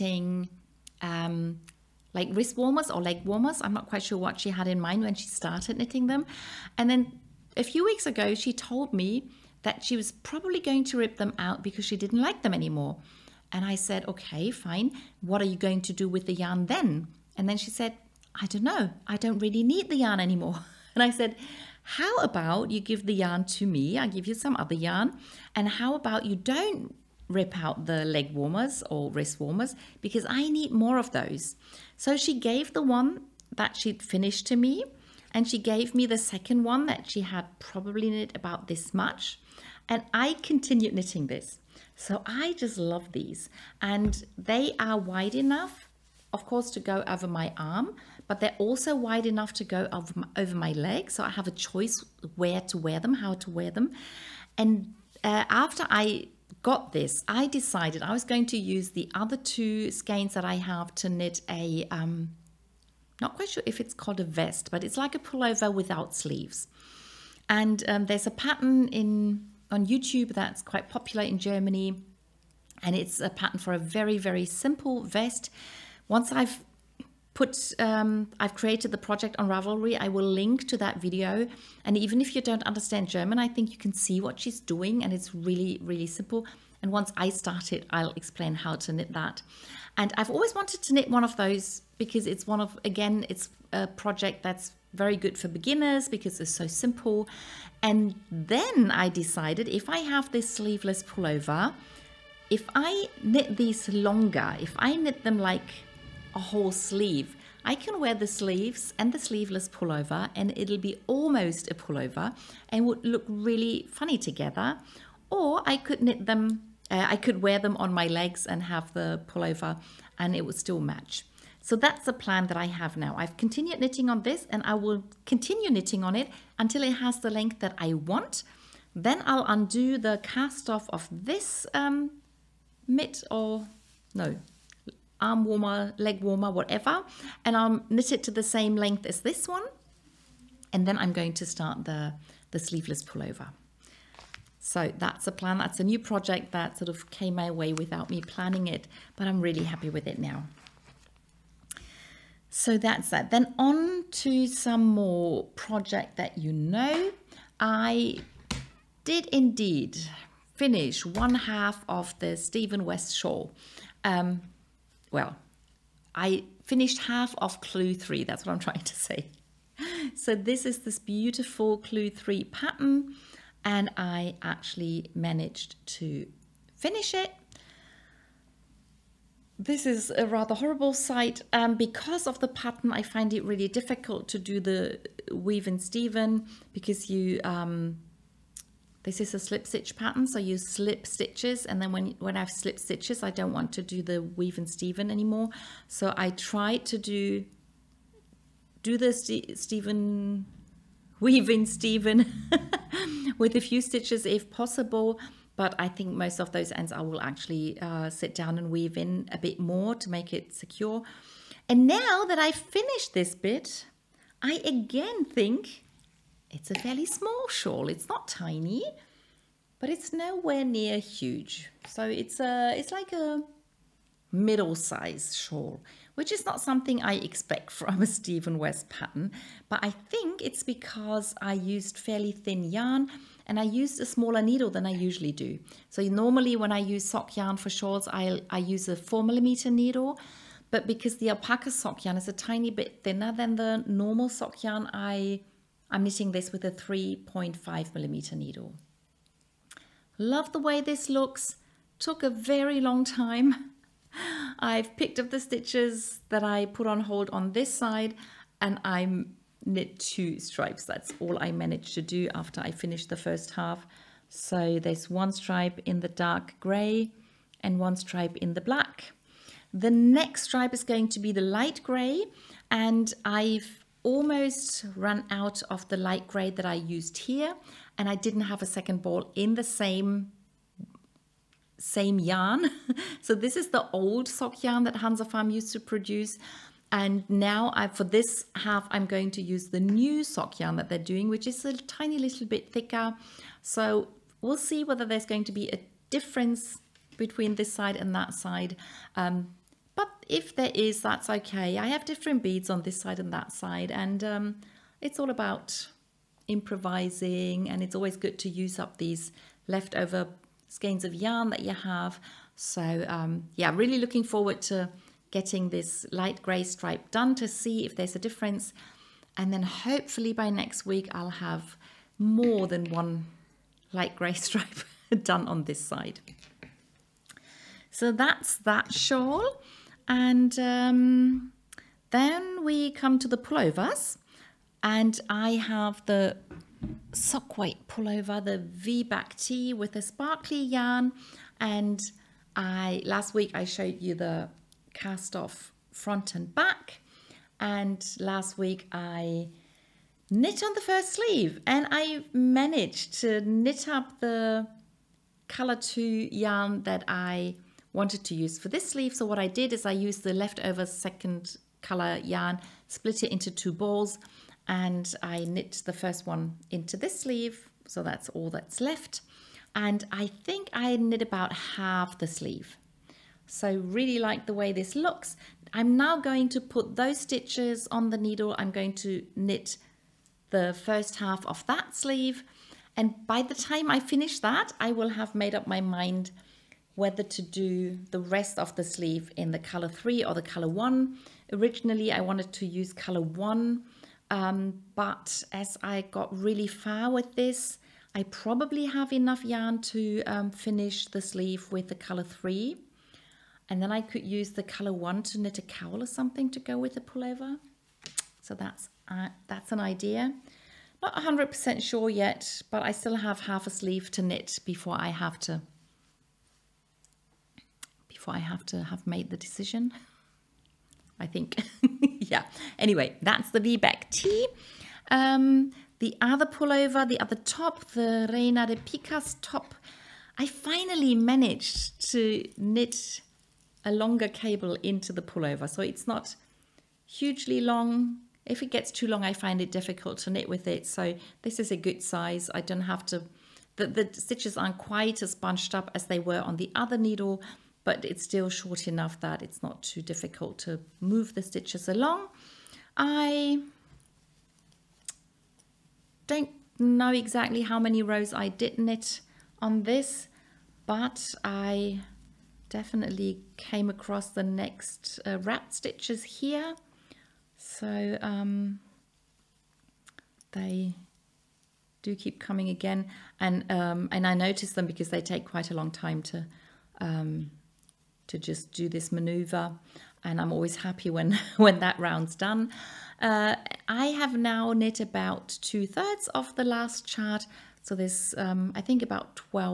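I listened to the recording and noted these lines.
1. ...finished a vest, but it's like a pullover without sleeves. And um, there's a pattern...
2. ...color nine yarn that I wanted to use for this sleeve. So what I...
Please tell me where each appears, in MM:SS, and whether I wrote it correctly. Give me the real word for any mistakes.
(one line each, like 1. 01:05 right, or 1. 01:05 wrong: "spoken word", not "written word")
1. 01:03 wrong: "called", not "finished"
2. 05:55 wrong: "two", not "nine".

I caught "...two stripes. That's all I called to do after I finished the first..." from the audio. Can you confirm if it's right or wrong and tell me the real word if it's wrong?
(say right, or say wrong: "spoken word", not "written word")
wrong: "managed", not "called".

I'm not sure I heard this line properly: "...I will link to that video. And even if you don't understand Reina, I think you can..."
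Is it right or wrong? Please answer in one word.
wrong.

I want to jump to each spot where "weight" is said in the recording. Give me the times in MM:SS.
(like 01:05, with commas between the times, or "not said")
05:37.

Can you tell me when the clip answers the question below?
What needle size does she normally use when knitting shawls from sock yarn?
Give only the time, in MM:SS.
03:58.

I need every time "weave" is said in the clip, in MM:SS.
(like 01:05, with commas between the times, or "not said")
03:05, 03:14, 03:28.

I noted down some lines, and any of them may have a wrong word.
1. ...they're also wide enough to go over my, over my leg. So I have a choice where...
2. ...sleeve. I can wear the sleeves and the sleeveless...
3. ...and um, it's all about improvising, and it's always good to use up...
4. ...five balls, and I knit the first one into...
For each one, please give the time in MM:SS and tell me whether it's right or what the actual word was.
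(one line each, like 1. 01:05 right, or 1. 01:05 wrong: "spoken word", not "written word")
1. 00:48 right
2. 01:46 right
3. 05:03 right
4. 06:03 wrong: "two", not "five".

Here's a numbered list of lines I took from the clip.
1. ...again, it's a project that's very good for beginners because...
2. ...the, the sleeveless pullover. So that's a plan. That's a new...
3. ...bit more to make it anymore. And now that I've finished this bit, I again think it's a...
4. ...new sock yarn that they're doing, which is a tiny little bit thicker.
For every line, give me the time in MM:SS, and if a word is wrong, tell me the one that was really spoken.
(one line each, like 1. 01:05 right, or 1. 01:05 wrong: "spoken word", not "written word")
1. 01:32 right
2. 02:21 right
3. 03:29 wrong: "secure", not "anymore"
4. 04:49 right.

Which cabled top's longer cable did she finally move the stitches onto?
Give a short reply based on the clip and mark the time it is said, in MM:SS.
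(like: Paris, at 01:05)
Reina de Picas, at 07:08.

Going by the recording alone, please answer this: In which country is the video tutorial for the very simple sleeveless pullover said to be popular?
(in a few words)
Germany.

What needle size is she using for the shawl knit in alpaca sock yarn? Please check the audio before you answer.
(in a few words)
3.5 mm.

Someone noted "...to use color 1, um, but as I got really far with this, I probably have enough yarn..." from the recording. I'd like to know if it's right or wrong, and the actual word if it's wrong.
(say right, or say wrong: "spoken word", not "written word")
right.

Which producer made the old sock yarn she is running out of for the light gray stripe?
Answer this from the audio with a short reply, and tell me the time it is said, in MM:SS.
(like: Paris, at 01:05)
Hansa Farm, at 04:44.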